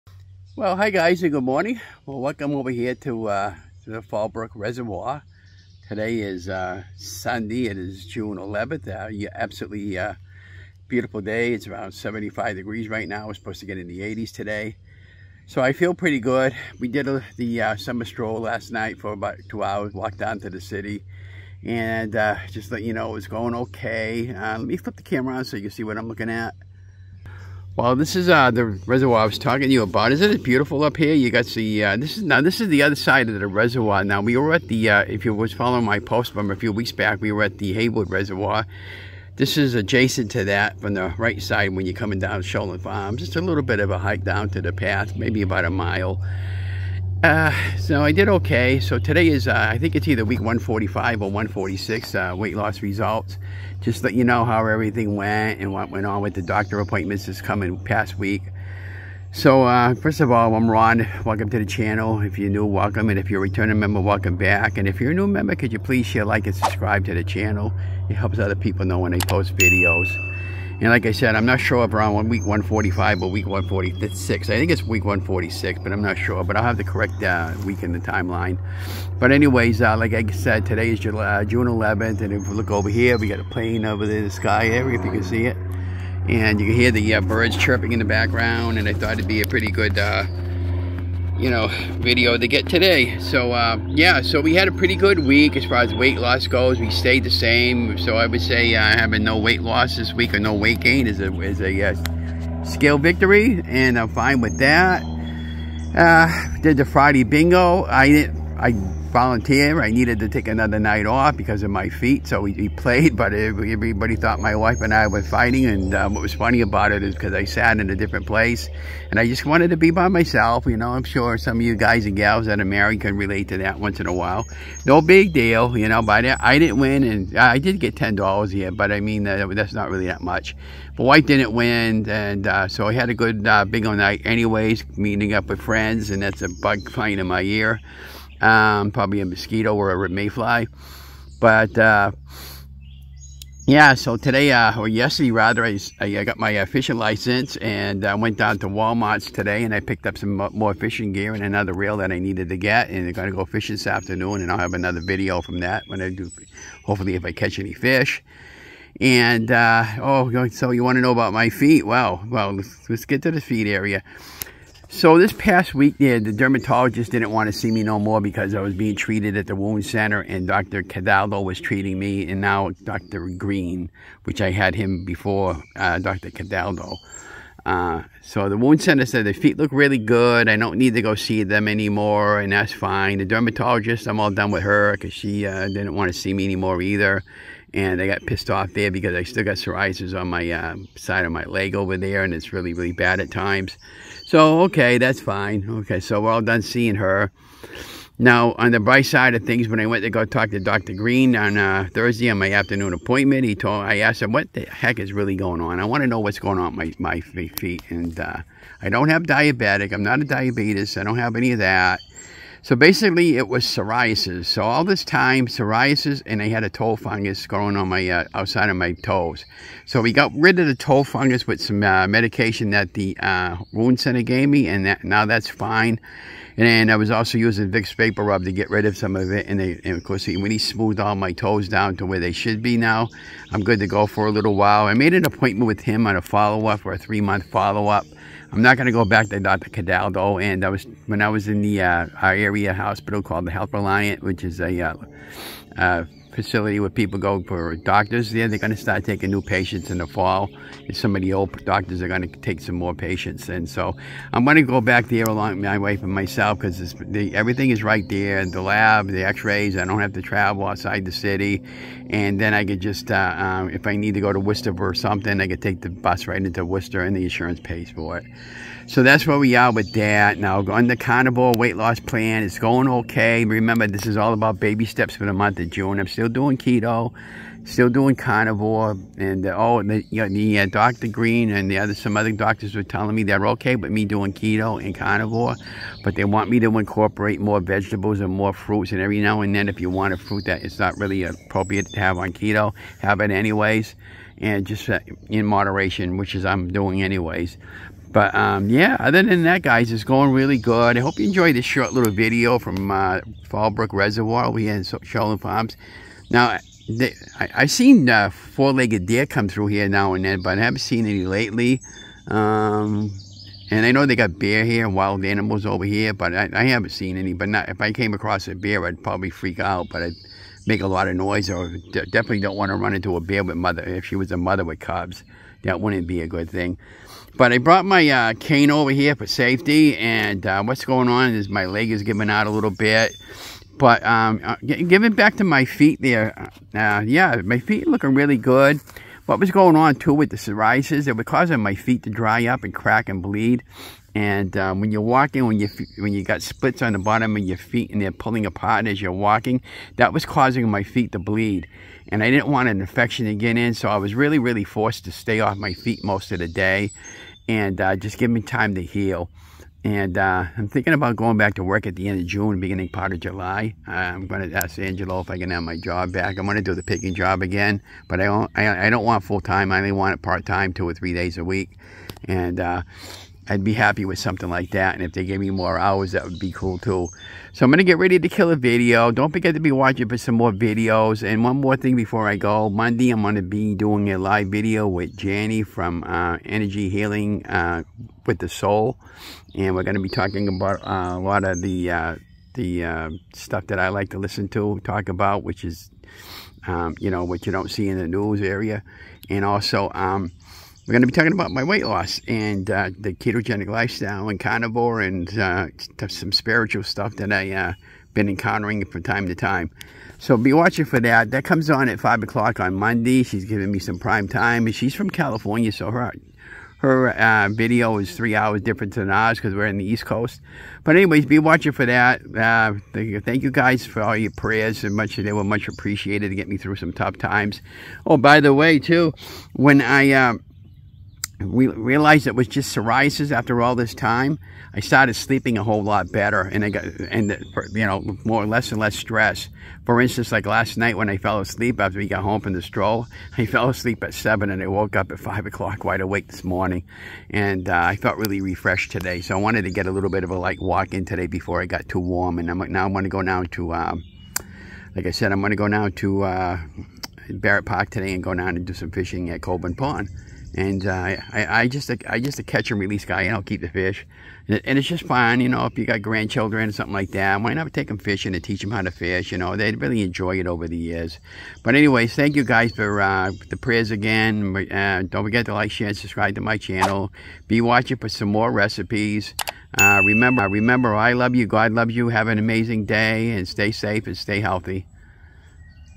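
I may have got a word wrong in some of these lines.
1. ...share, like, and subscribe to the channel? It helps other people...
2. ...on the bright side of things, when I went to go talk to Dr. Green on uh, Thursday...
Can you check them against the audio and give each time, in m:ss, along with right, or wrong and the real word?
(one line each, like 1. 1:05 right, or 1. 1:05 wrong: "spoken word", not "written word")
1. 1:06 right
2. 3:18 right.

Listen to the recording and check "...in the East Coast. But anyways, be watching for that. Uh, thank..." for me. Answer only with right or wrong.
right.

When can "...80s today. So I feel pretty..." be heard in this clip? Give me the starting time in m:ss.
0:13.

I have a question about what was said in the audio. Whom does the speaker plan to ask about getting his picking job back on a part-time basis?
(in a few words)
Angelo.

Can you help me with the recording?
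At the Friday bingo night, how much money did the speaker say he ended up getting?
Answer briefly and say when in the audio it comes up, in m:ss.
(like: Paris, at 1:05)
$10, at 2:07.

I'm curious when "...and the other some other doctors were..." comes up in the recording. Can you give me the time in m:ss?
4:41.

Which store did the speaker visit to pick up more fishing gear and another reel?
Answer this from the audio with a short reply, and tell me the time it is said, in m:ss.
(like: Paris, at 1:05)
Walmart, at 2:28.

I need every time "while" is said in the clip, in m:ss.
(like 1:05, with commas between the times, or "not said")
2:04, 3:54.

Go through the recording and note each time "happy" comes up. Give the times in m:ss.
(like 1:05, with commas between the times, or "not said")
6:13.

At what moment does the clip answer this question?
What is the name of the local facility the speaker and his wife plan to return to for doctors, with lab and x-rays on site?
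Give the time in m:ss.
4:03.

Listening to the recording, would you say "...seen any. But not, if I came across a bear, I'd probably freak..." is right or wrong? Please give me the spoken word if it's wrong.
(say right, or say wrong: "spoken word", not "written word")
right.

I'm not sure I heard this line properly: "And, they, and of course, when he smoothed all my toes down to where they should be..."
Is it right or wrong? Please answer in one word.
right.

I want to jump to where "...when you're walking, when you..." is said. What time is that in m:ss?
5:44.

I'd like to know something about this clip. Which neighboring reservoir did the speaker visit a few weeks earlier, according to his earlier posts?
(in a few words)
Haywood Reservoir.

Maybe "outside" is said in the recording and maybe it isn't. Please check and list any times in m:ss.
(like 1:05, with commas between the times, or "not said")
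3:38, 4:20.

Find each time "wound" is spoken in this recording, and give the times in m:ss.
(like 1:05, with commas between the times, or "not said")
2:49, 2:58, 3:43.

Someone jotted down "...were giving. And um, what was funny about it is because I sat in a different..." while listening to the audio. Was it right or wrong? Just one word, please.
wrong.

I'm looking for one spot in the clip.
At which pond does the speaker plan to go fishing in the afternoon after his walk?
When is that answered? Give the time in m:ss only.
7:39.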